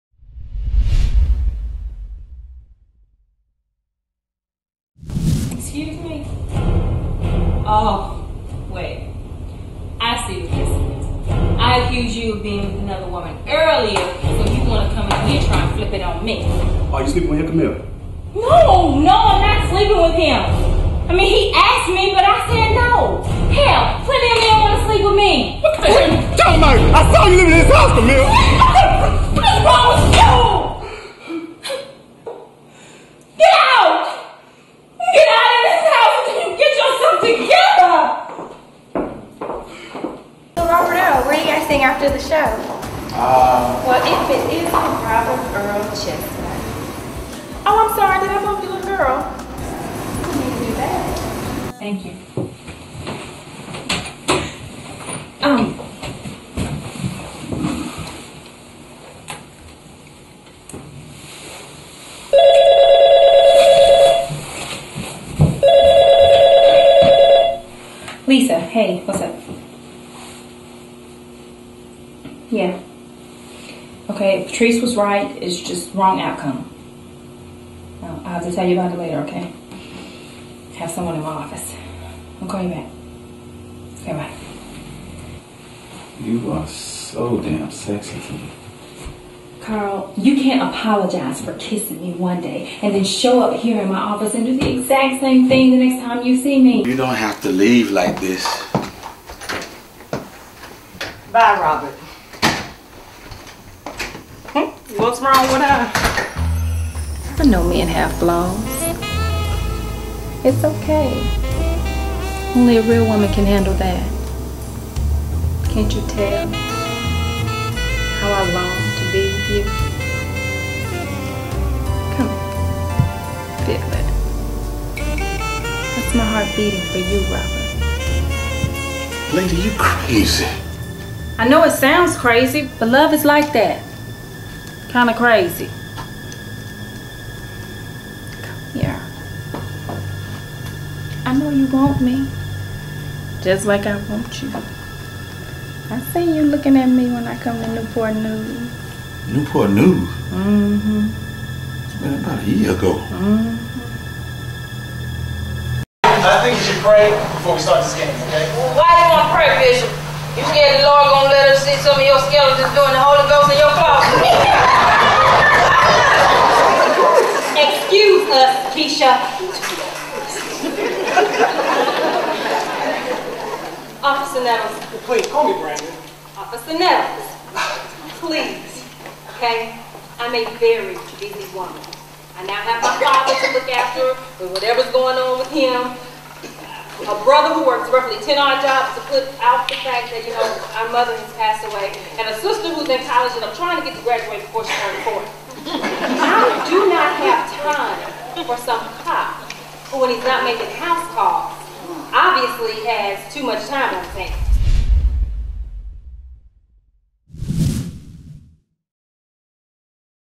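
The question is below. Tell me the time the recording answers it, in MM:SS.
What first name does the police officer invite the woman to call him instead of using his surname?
02:55.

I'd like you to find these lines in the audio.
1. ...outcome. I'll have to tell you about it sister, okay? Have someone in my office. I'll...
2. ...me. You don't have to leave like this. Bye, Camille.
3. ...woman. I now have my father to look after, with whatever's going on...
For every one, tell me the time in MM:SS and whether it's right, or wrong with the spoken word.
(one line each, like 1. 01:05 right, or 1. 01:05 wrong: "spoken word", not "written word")
1. 01:16 wrong: "later", not "sister"
2. 01:36 wrong: "Robert", not "Camille"
3. 03:01 right.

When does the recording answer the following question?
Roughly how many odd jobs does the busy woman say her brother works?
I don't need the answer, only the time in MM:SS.
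03:08.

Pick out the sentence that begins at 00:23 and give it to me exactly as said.
Hell, plenty of men want to sleep with me.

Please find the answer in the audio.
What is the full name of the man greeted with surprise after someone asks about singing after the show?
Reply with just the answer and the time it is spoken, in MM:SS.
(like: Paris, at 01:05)
Robert Earl Chestnut, at 00:45.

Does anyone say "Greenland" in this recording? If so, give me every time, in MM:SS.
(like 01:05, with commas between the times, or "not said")
not said.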